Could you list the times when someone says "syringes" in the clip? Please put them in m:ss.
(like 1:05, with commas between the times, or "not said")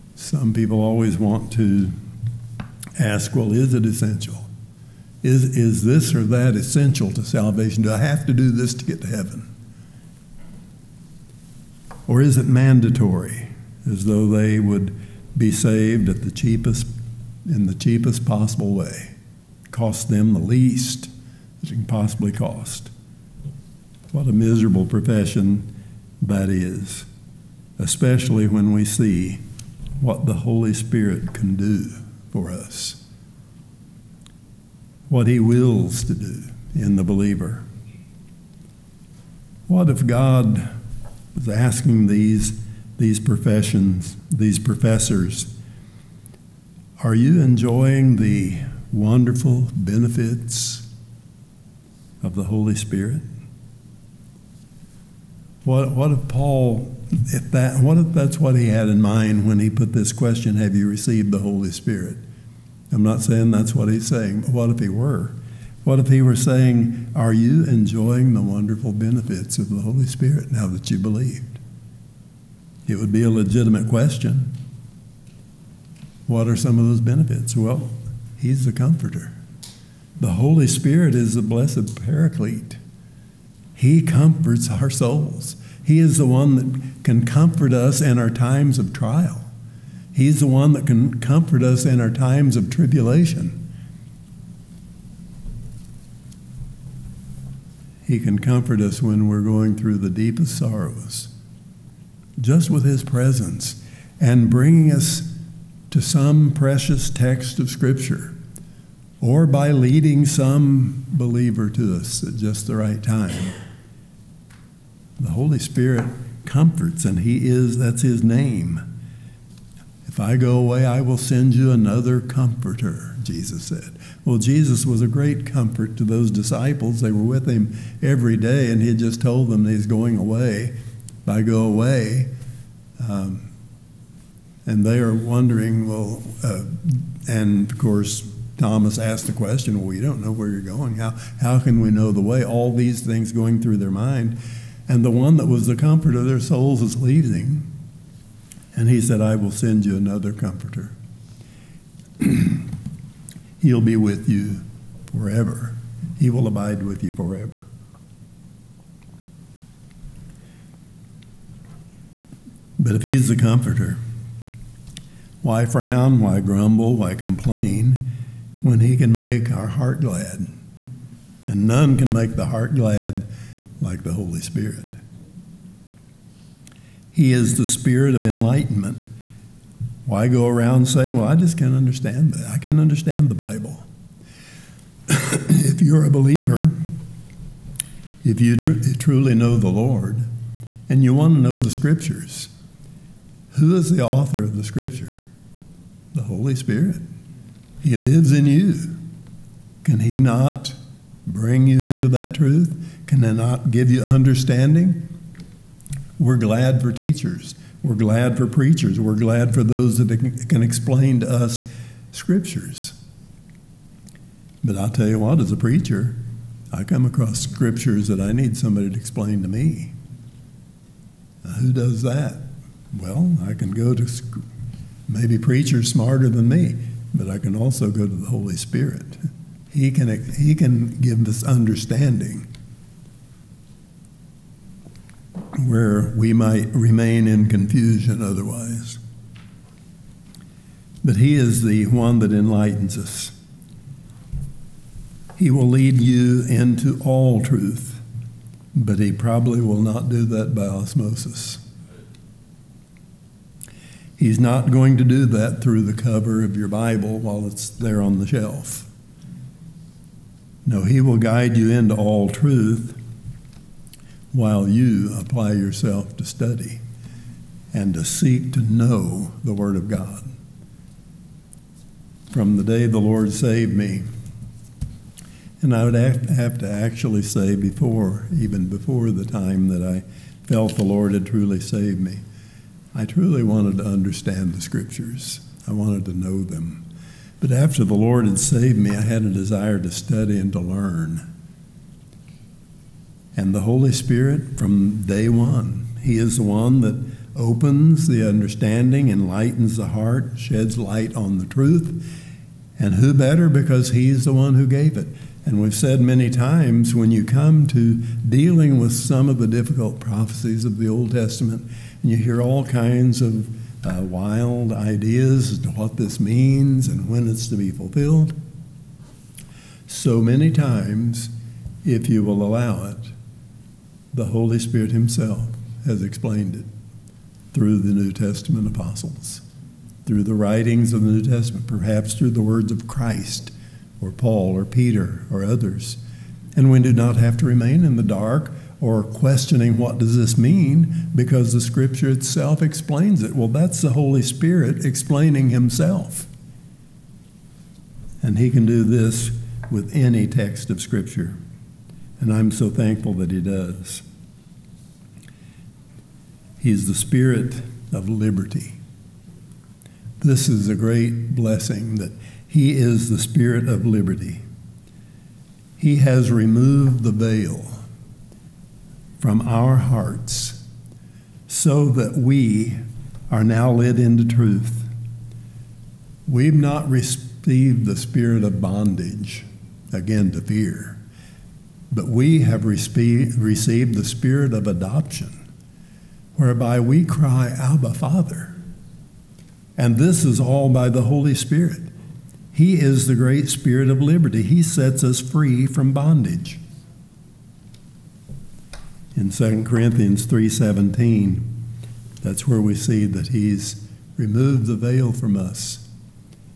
not said.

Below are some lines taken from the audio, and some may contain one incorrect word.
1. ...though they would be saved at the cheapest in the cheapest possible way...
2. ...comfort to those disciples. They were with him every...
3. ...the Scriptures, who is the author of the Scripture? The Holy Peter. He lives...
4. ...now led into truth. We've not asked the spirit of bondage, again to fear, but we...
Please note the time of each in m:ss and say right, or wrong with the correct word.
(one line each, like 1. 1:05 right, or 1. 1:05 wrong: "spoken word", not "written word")
1. 0:14 right
2. 2:05 right
3. 3:11 wrong: "Spirit", not "Peter"
4. 6:13 wrong: "received", not "asked".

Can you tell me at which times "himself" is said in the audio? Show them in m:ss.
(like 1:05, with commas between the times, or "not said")
5:24, 5:45.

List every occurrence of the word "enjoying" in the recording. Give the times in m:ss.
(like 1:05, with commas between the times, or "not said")
0:47, 1:07.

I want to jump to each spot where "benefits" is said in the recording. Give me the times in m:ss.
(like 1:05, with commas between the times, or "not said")
0:49, 1:08, 1:17.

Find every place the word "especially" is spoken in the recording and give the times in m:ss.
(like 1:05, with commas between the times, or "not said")
0:27.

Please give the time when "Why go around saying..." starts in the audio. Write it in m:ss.
3:00.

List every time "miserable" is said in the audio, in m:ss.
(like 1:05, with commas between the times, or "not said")
0:24.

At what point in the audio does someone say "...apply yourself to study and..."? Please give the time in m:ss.
4:25.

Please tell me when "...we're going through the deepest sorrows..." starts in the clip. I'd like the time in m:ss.
1:39.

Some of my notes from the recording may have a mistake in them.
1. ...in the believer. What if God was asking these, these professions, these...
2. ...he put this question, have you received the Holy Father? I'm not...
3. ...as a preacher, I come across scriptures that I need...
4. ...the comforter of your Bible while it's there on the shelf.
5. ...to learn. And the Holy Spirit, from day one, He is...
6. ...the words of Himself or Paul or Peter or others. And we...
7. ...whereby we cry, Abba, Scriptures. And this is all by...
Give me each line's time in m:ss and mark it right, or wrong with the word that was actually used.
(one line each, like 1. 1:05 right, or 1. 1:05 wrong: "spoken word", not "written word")
1. 0:36 right
2. 0:59 wrong: "Spirit", not "Father"
3. 3:35 right
4. 4:15 wrong: "cover", not "comforter"
5. 4:50 right
6. 5:32 wrong: "Christ", not "Himself"
7. 6:26 wrong: "Father", not "Scriptures".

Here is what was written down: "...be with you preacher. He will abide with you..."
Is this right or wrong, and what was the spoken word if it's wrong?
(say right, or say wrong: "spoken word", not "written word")
wrong: "forever", not "preacher".